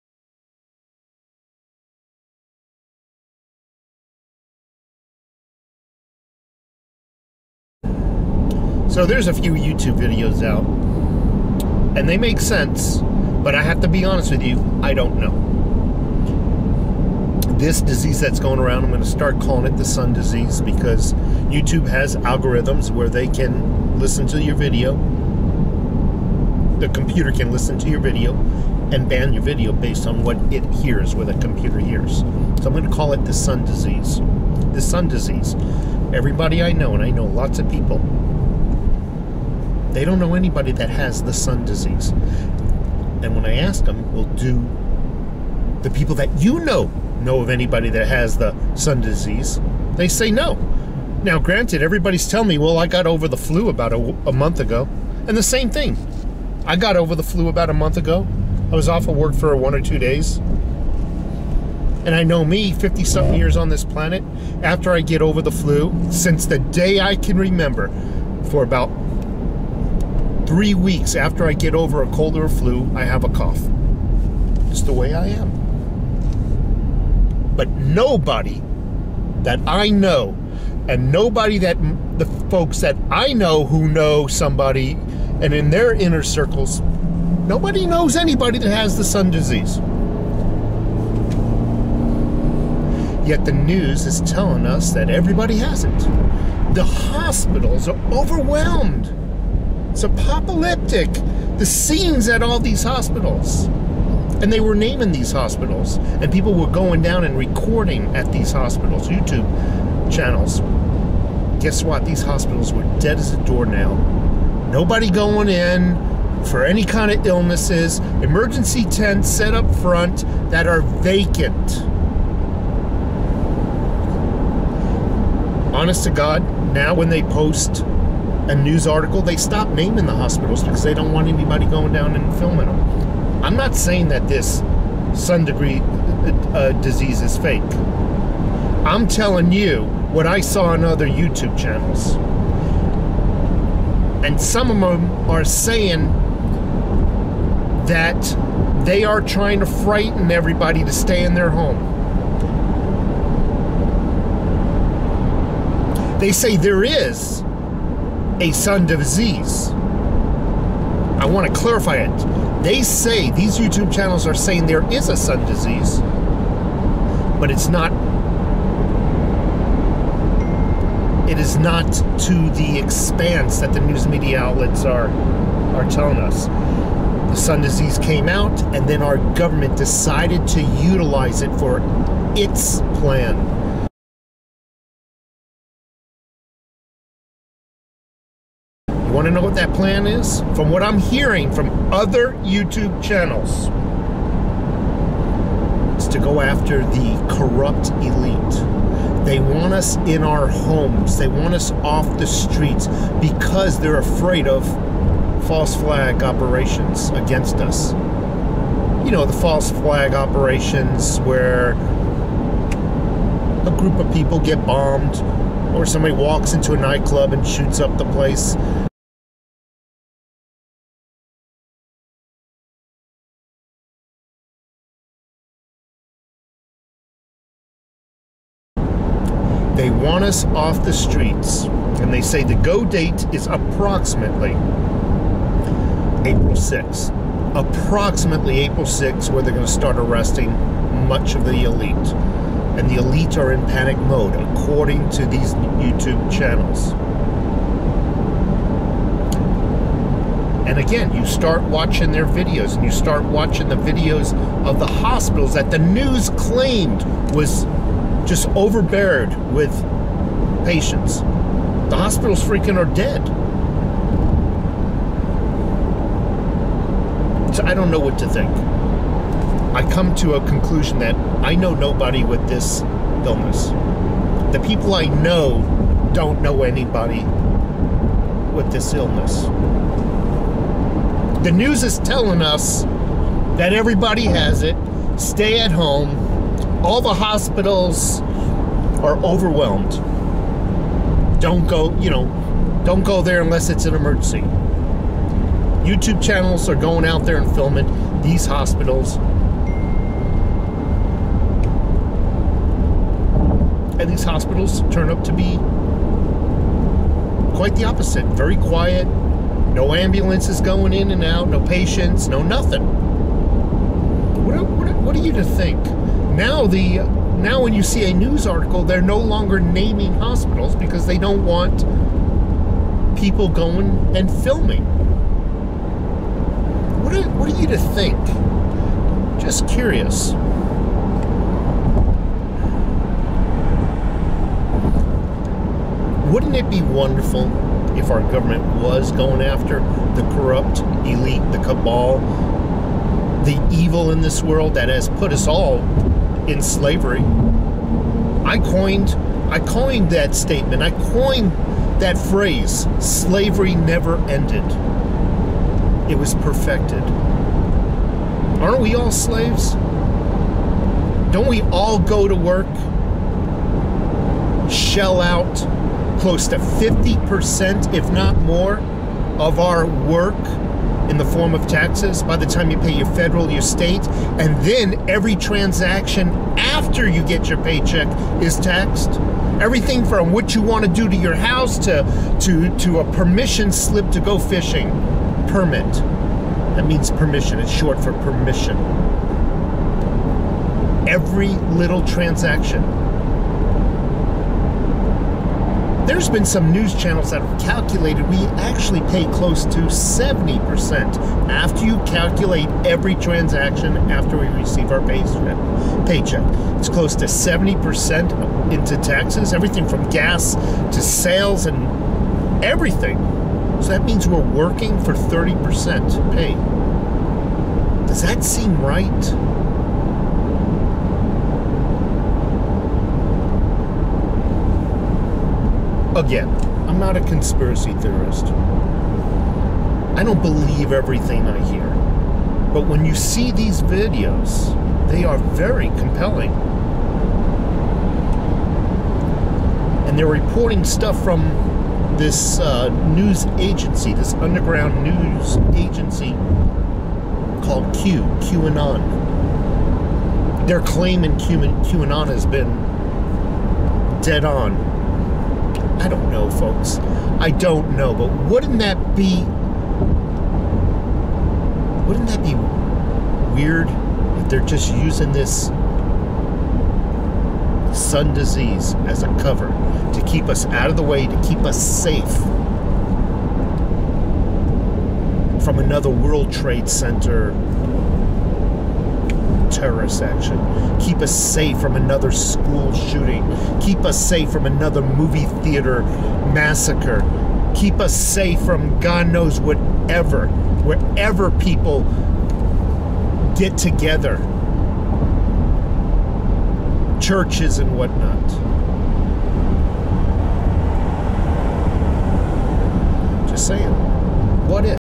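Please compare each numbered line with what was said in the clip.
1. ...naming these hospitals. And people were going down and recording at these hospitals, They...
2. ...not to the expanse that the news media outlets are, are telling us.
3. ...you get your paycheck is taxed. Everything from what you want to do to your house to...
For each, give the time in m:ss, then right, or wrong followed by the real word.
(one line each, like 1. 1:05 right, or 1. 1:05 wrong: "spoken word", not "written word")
1. 1:44 wrong: "YouTube", not "They"
2. 2:51 right
3. 6:17 right.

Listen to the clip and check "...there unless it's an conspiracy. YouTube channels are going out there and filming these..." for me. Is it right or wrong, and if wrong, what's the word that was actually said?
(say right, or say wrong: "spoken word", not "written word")
wrong: "emergency", not "conspiracy".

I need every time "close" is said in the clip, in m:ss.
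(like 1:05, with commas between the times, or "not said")
6:06, 6:39, 6:46.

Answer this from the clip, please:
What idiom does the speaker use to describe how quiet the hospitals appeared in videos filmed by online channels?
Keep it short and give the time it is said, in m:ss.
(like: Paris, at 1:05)
dead as a doornail, at 1:52.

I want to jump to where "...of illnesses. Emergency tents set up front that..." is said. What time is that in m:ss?
1:57.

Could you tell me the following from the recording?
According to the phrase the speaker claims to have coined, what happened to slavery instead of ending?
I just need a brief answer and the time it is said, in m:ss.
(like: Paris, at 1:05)
perfected, at 5:56.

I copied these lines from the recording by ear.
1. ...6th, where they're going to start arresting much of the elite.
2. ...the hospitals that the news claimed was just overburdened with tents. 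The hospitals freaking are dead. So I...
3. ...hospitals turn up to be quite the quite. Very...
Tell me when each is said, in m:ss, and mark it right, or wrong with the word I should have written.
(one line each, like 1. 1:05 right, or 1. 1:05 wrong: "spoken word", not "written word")
1. 3:58 right
2. 4:14 wrong: "patients", not "tents"
3. 5:04 wrong: "opposite", not "quite".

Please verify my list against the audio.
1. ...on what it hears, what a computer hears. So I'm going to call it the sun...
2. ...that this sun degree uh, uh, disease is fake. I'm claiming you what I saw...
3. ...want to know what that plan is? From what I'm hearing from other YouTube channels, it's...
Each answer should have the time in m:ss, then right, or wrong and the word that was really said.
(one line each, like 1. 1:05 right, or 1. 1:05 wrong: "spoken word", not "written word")
1. 0:30 right
2. 2:14 wrong: "telling", not "claiming"
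3. 3:09 right.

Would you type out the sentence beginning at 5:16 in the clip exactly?
now the now when you see a news article, they're no longer naming hospitals because they don't want people going and filming.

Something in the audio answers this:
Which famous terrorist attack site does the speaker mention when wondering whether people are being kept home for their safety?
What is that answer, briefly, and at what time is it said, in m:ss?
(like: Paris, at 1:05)
World Trade Center, at 7:56.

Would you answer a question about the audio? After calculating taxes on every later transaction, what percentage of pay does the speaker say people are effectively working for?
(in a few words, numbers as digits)
30%.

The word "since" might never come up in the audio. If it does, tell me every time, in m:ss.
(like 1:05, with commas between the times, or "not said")
1:06.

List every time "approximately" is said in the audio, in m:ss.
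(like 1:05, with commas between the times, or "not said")
3:53, 3:57.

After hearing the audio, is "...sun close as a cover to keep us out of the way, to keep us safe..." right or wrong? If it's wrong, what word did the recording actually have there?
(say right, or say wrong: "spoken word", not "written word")
wrong: "disease", not "close".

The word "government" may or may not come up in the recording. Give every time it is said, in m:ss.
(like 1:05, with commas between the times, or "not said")
2:59, 5:38.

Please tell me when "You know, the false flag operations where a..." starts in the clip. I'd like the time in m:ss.
3:29.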